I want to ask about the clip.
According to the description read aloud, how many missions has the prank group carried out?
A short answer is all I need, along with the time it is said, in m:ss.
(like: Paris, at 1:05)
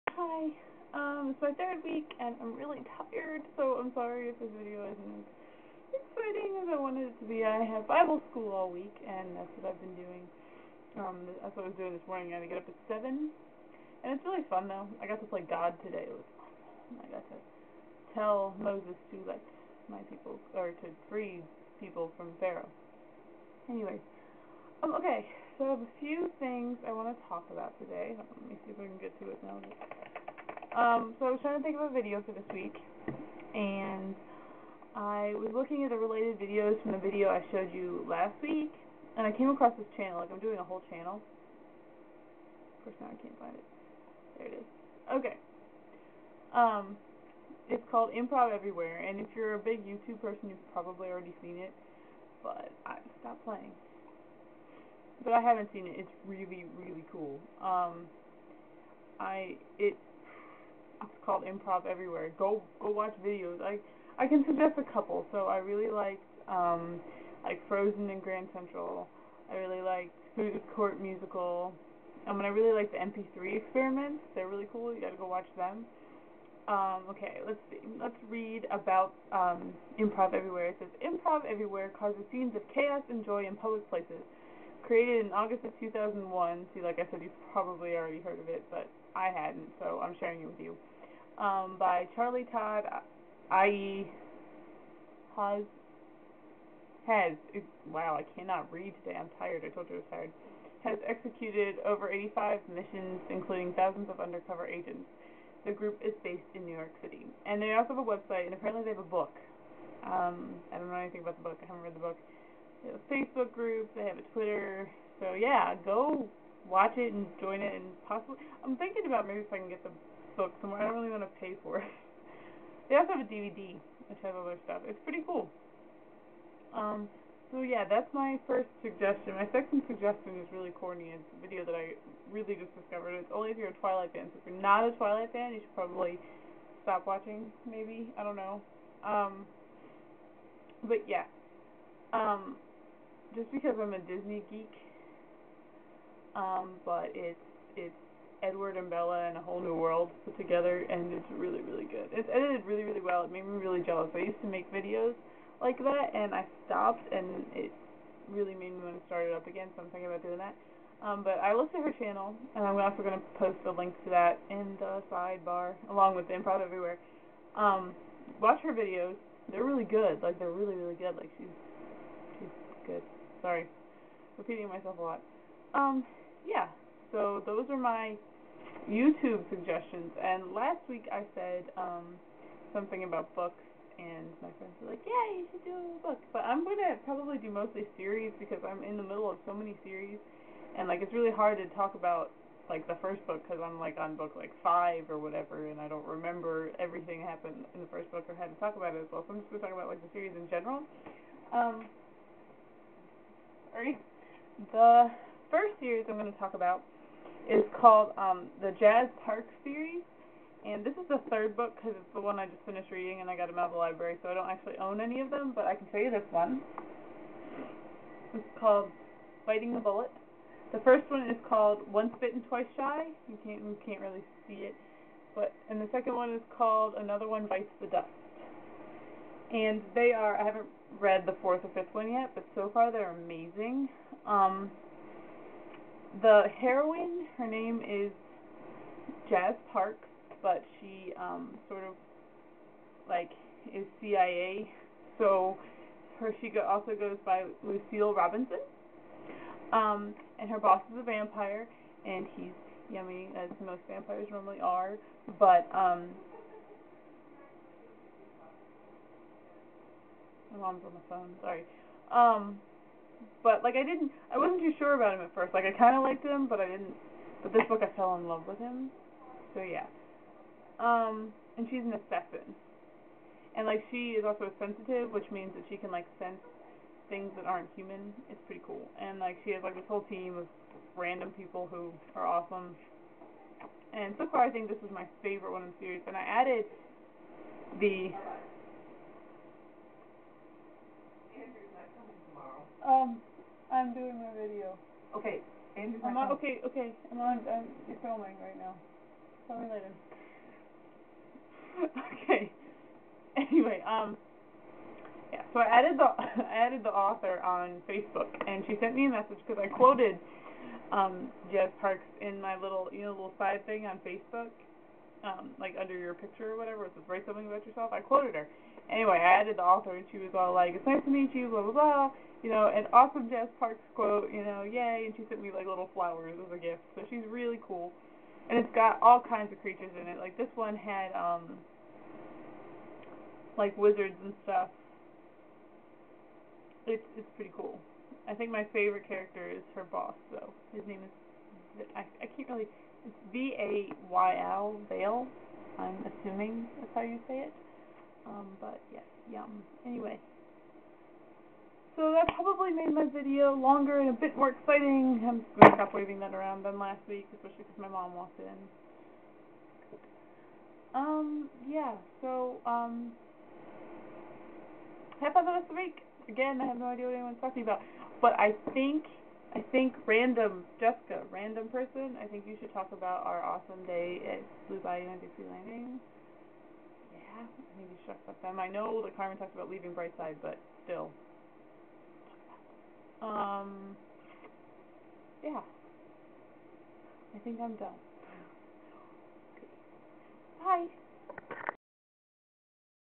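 over 85, at 1:41.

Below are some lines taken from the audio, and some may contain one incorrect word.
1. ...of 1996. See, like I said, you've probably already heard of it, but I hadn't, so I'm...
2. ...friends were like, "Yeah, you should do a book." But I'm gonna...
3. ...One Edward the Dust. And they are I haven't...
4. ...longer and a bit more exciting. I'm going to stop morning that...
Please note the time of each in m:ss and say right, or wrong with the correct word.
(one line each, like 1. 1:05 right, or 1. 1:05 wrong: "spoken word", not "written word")
1. 1:25 wrong: "2001", not "1996"
2. 3:04 right
3. 3:47 wrong: "Bites", not "Edward"
4. 5:53 wrong: "waving", not "morning".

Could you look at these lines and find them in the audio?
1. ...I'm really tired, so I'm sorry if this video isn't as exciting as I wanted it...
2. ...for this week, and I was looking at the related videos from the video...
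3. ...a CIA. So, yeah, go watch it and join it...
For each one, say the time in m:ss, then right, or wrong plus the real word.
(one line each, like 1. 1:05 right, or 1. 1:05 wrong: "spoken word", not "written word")
1. 0:02 right
2. 0:32 right
3. 1:54 wrong: "Twitter", not "CIA".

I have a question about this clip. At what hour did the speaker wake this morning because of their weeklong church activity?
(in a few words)
7.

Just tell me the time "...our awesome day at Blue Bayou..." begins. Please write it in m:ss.
6:13.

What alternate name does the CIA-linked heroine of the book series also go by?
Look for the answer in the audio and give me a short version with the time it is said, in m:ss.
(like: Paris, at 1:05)
Lucille Robinson, at 4:07.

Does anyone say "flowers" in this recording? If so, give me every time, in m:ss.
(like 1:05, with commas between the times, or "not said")
5:25.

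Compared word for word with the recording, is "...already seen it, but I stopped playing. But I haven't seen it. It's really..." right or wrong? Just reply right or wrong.
right.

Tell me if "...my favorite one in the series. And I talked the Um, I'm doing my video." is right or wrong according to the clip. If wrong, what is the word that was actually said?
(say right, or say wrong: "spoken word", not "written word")
wrong: "added", not "talked".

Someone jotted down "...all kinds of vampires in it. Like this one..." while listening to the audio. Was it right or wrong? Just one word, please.
wrong.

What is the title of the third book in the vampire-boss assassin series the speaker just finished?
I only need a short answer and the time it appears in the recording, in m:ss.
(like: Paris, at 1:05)
Biting the Bullet, at 3:39.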